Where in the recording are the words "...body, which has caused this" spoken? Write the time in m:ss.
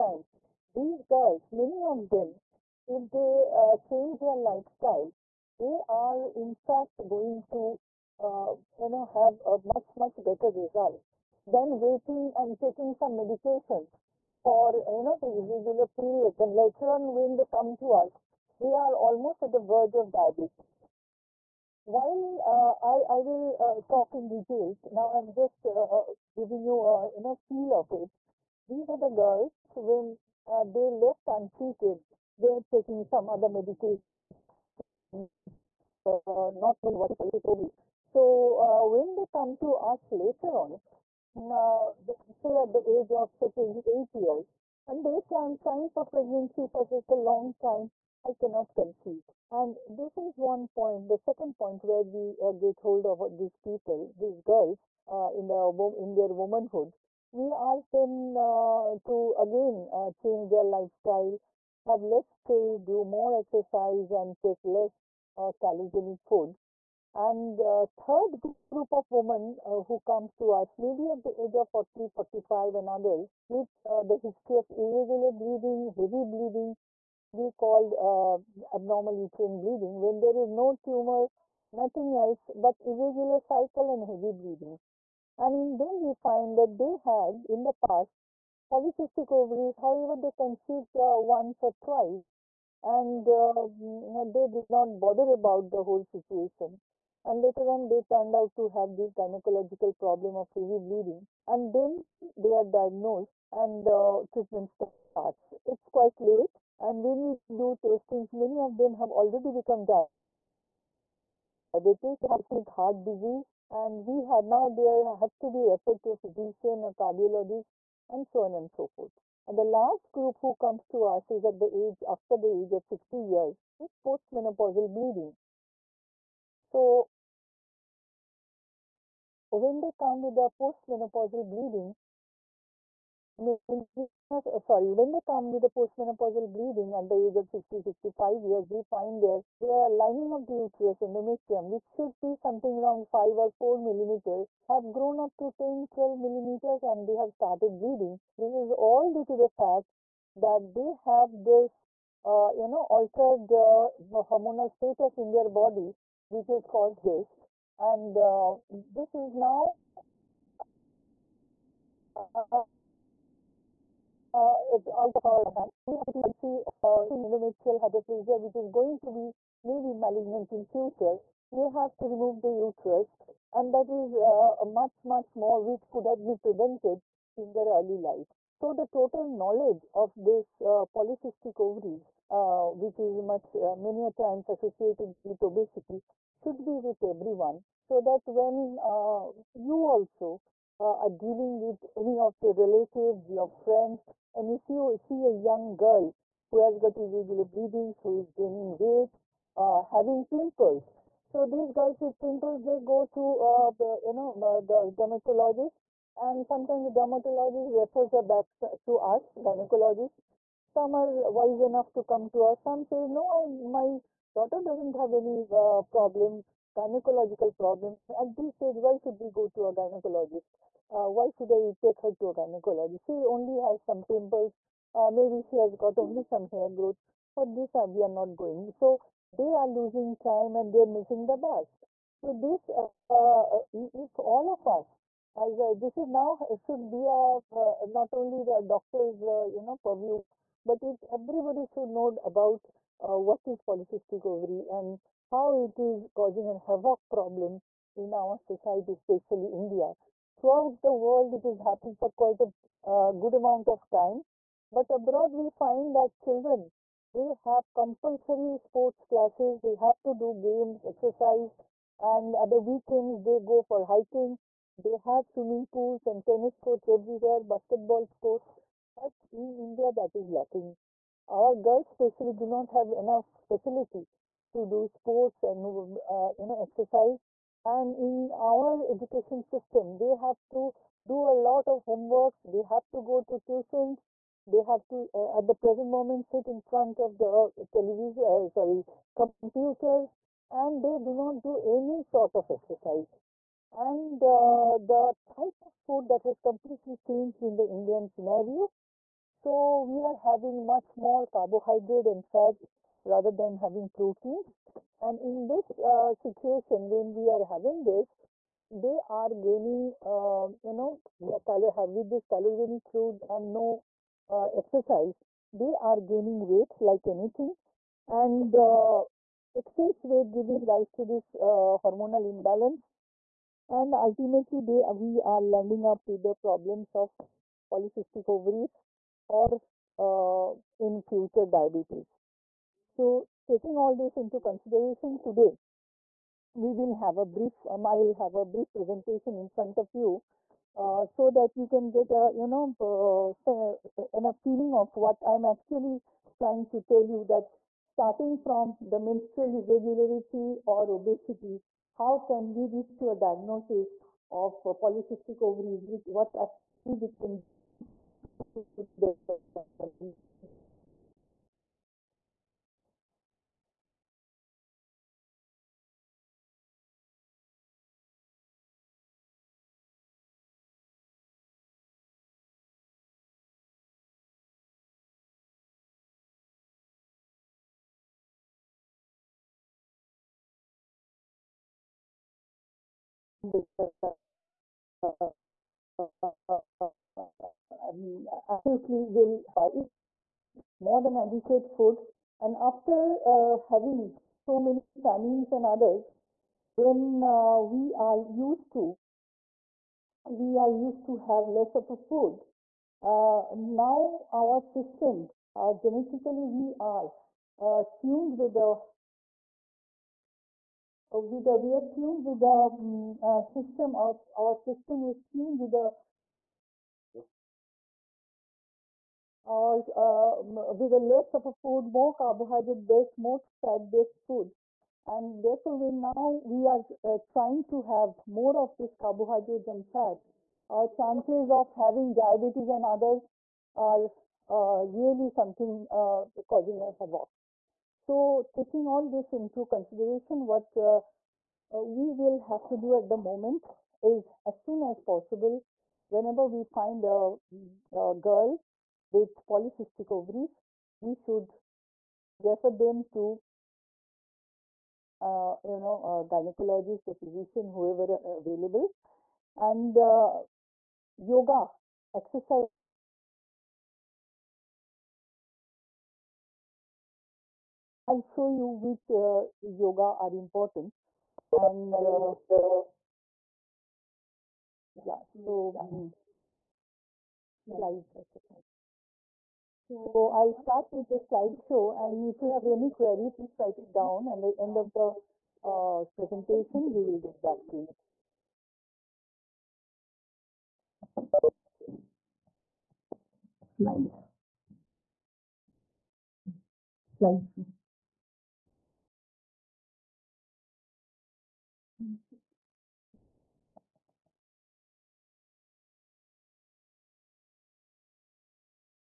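2:35.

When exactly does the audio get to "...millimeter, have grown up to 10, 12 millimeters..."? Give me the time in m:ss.
2:23.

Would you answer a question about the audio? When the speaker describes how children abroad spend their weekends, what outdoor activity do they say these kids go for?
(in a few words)
Hiking.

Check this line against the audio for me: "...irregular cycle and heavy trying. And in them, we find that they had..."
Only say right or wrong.
wrong.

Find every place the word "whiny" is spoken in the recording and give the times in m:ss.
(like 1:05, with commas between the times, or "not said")
not said.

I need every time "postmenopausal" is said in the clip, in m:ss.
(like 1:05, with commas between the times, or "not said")
2:04, 2:10, 2:15.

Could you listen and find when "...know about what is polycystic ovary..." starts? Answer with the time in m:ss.
4:01.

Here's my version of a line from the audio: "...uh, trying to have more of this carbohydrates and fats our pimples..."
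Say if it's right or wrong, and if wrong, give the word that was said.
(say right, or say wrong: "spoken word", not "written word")
wrong: "chances", not "pimples".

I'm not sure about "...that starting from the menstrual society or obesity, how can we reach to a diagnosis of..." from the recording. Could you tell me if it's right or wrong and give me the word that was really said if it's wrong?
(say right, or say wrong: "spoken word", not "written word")
wrong: "irregularity", not "society".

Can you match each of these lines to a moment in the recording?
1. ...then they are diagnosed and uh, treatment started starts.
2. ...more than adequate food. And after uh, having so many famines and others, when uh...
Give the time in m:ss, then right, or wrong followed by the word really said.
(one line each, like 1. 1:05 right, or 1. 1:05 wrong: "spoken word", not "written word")
1. 1:41 right
2. 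6:30 right.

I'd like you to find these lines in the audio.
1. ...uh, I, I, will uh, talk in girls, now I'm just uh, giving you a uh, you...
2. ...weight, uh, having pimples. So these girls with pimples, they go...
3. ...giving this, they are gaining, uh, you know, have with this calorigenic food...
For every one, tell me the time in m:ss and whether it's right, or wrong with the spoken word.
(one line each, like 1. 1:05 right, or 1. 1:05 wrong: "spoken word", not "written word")
1. 0:22 wrong: "details", not "girls"
2. 3:18 right
3. 5:07 wrong: "having", not "giving".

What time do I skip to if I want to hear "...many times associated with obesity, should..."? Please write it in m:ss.
3:03.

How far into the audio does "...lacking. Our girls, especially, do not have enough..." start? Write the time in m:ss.
4:30.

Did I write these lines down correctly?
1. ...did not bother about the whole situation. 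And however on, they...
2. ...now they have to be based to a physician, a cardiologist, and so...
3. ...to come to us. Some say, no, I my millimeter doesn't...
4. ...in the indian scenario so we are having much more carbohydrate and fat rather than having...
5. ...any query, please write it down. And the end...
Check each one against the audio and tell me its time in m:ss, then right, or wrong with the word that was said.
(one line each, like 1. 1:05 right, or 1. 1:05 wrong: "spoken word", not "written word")
1. 1:34 wrong: "later", not "however"
2. 1:54 wrong: "referred", not "based"
3. 3:31 wrong: "daughter", not "millimeter"
4. 4:57 right
5. 8:02 right.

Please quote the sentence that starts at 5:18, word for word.
And uh, excess weight giving rise to this uh, hormonal imbalance.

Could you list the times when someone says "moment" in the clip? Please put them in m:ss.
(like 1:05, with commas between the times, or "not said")
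4:45, 7:23.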